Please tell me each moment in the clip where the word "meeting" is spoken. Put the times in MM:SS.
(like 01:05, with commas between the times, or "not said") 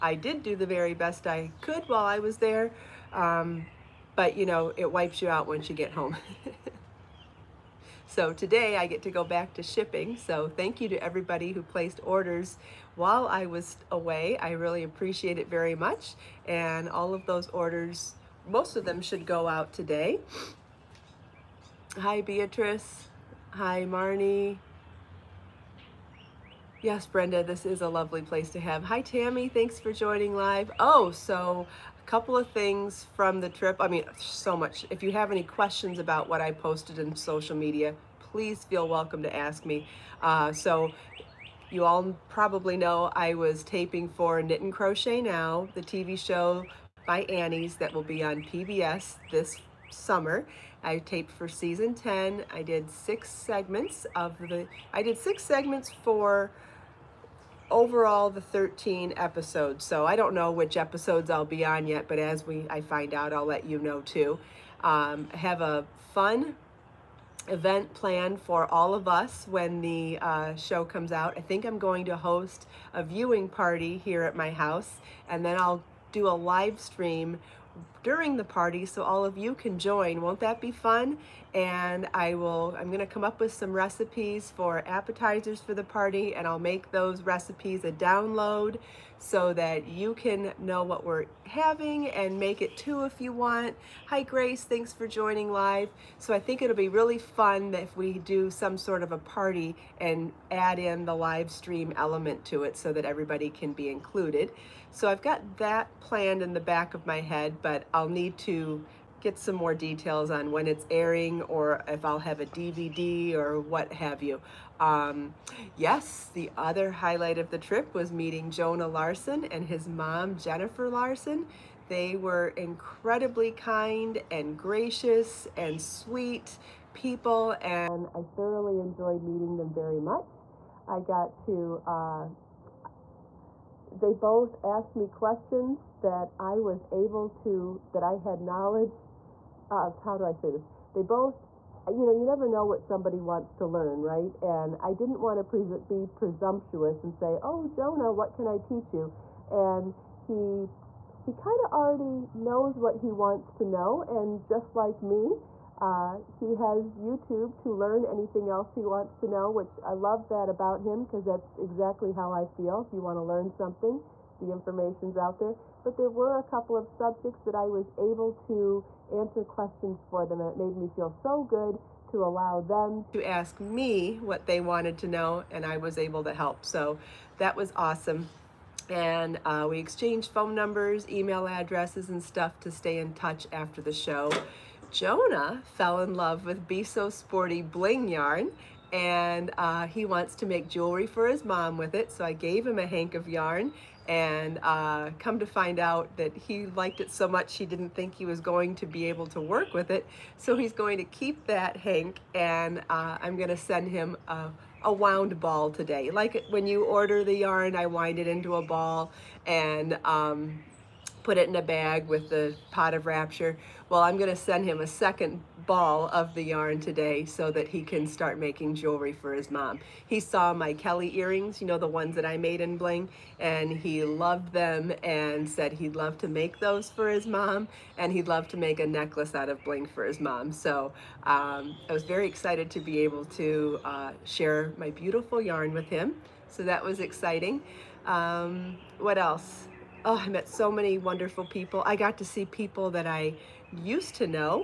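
01:58, 02:09.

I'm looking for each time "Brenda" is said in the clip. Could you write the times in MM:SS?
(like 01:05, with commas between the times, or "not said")
00:27.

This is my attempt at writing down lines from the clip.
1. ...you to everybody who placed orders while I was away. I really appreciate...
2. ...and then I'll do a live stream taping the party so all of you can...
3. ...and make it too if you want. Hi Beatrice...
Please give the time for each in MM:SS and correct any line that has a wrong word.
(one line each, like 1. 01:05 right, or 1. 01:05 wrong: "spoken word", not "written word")
1. 00:10 right
2. 01:15 wrong: "during", not "taping"
3. 01:32 wrong: "Grace", not "Beatrice".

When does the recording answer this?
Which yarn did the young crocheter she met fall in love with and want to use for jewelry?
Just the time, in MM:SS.
03:06.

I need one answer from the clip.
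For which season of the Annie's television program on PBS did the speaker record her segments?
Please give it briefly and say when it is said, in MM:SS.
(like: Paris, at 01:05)
10, at 00:51.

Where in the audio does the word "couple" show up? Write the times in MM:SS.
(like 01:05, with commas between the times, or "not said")
00:32, 02:46.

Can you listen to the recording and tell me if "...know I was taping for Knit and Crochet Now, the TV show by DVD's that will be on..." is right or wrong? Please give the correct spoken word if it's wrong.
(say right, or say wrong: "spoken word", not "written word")
wrong: "Annie", not "DVD".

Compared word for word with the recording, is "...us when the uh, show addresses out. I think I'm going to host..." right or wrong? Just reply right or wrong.
wrong.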